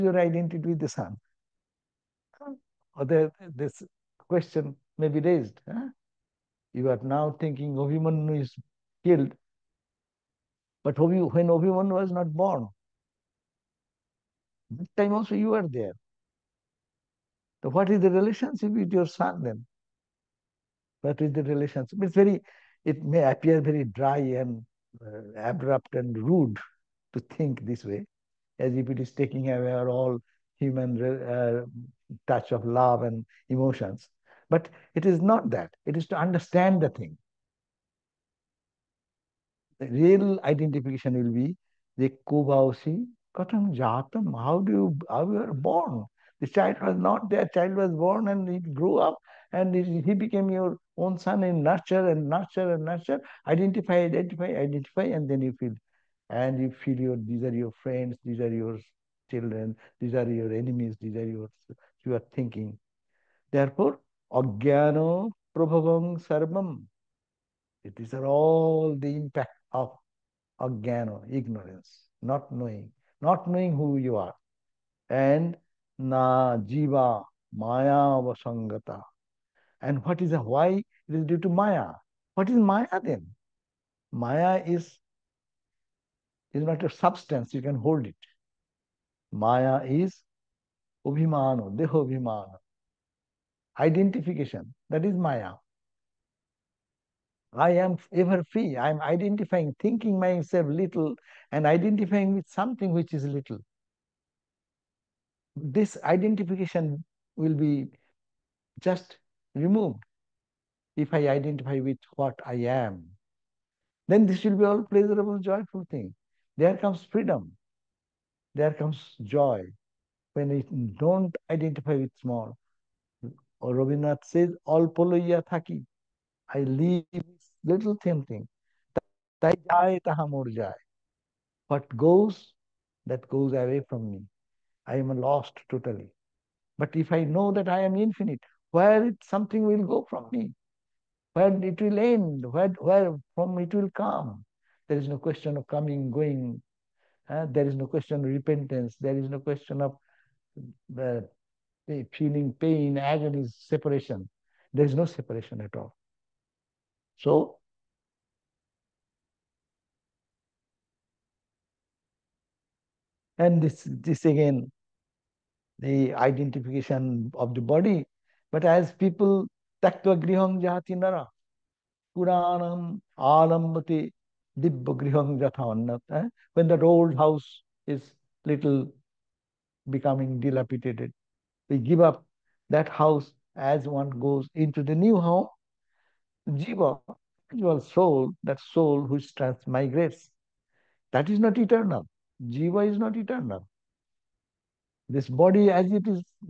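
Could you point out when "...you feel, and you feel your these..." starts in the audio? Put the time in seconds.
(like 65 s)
55 s.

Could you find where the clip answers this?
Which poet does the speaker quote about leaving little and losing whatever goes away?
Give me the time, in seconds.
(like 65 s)
123 s.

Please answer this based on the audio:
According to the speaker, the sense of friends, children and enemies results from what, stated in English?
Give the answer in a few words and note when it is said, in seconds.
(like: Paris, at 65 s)
ignorance, at 71 s.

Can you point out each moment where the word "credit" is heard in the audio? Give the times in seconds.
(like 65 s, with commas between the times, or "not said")
not said.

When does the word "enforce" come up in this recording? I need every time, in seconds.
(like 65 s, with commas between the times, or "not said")
not said.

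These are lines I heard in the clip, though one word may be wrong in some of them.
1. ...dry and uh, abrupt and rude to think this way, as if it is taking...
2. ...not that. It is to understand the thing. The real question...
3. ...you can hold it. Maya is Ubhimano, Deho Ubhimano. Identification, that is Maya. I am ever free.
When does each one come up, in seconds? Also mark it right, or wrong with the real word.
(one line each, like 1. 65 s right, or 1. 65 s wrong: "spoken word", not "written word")
1. 23 s right
2. 35 s wrong: "identification", not "question"
3. 87 s right.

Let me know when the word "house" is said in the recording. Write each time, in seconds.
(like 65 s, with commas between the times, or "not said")
177 s, 182 s.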